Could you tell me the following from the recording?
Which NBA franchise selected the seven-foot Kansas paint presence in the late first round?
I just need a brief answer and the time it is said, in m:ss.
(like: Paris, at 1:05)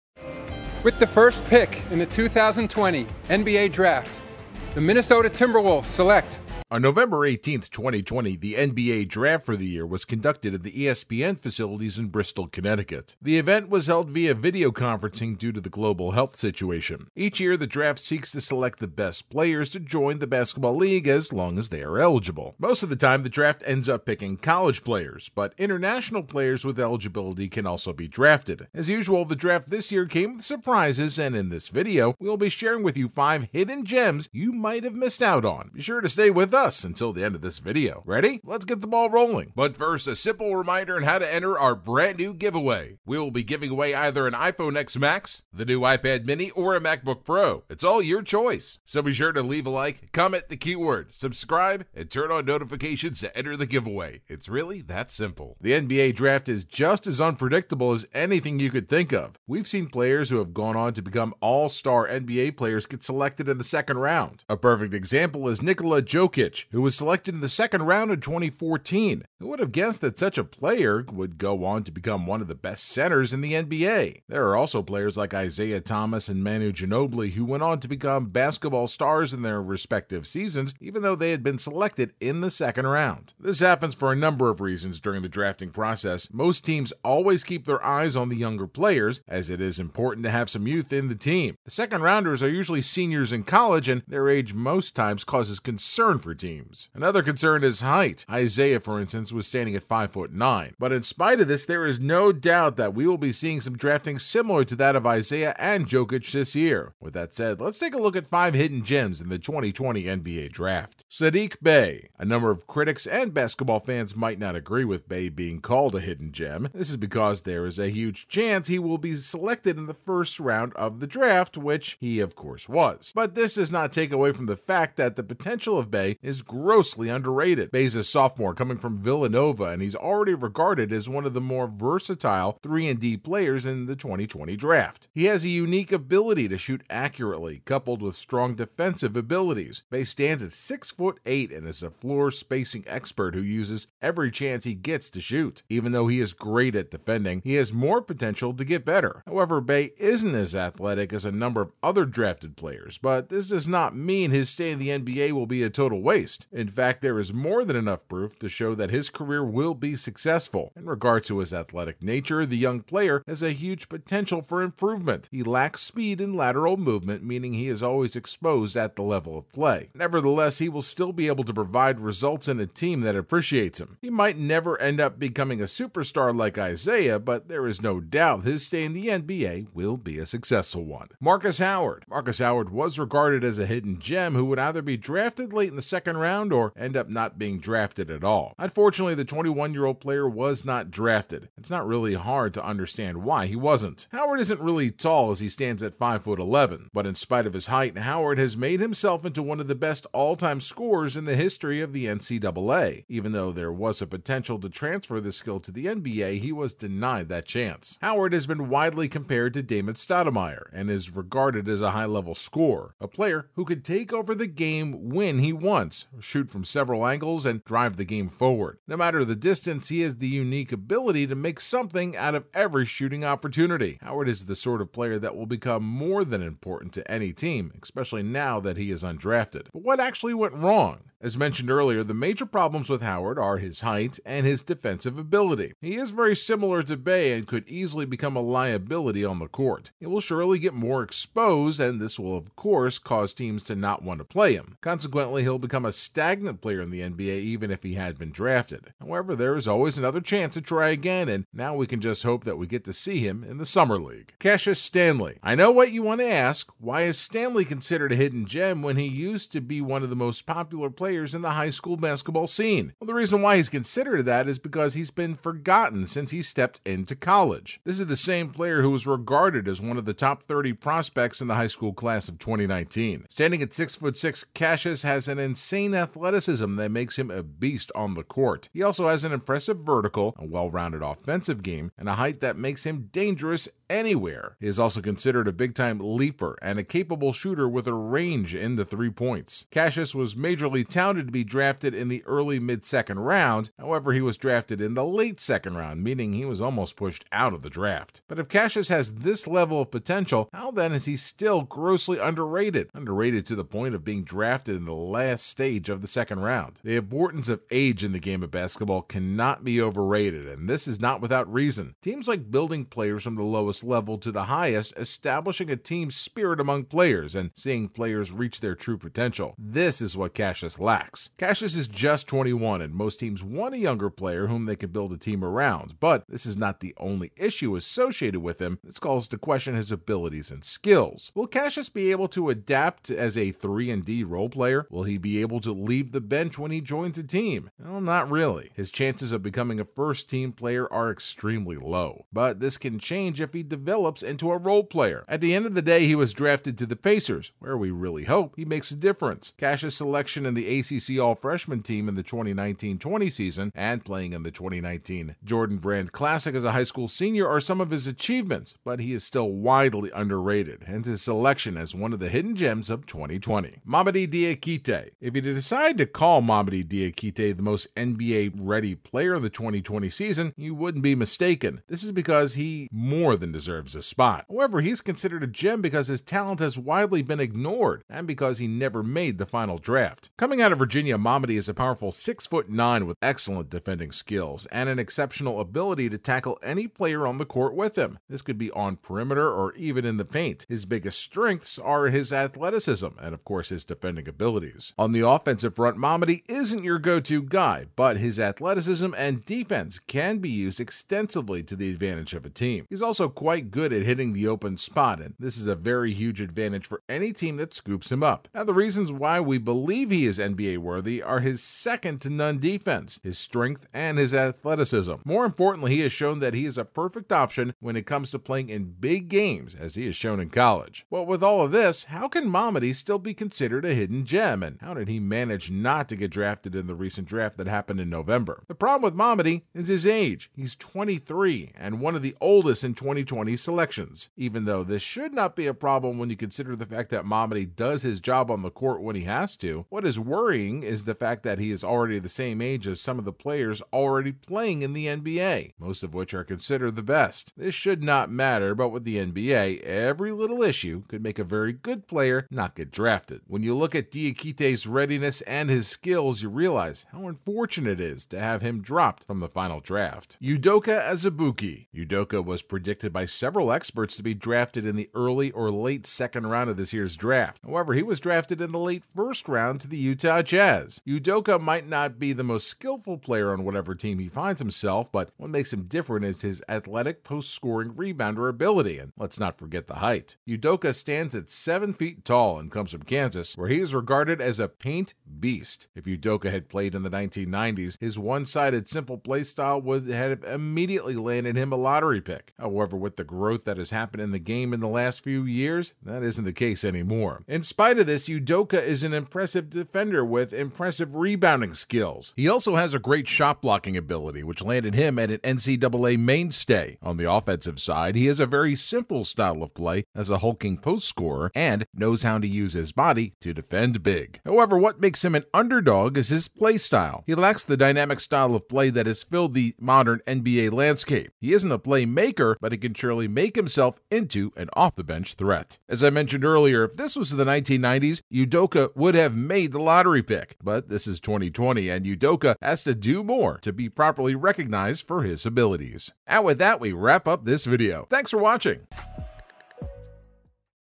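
Utah Jazz, at 7:49.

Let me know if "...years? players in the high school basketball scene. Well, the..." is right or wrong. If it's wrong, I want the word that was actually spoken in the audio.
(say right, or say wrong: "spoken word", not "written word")
wrong: "players", not "years".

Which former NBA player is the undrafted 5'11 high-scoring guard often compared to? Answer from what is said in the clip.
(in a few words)
Damon Stoudemire.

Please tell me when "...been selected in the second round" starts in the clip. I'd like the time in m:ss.
1:21.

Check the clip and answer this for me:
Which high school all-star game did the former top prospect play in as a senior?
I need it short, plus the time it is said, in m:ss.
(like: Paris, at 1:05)
Jordan Brand Classic, at 5:55.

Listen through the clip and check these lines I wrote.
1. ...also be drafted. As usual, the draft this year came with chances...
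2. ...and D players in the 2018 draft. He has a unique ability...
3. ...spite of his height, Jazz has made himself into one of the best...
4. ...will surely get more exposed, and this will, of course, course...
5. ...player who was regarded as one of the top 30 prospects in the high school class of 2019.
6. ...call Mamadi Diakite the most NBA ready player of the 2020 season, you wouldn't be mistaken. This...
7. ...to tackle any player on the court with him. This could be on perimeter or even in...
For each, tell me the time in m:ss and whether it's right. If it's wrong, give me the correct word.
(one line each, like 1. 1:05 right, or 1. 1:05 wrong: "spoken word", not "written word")
1. 0:27 wrong: "surprises", not "chances"
2. 2:12 wrong: "2020", not "2018"
3. 3:17 wrong: "Howard", not "Jazz"
4. 4:00 wrong: "cause", not "course"
5. 4:28 right
6. 6:06 right
7. 6:26 right.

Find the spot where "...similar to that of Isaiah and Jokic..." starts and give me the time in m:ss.
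1:44.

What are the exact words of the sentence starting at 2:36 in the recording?
In fact, there is more than enough proof to show that his career will be successful.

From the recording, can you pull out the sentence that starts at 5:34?
Will he be able to leave the bench when he joins a team?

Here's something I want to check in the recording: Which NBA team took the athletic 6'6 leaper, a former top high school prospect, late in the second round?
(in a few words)
Pacers.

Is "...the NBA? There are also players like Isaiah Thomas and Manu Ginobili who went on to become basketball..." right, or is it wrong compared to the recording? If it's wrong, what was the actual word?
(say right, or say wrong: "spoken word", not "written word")
right.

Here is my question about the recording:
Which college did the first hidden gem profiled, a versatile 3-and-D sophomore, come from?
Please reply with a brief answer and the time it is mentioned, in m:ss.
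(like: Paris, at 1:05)
Villanova, at 2:08.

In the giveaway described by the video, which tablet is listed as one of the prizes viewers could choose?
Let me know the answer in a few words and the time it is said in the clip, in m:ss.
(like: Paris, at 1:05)
iPad mini, at 0:45.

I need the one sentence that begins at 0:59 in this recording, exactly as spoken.
We've seen players who have gone on to become all-star NBA players get selected in the second round.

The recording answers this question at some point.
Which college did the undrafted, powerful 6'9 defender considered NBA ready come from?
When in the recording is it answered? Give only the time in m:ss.
6:20.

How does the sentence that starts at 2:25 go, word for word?
Even though he is great at defending, he has more potential to get better.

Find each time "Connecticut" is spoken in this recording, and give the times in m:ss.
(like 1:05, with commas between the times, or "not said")
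0:12.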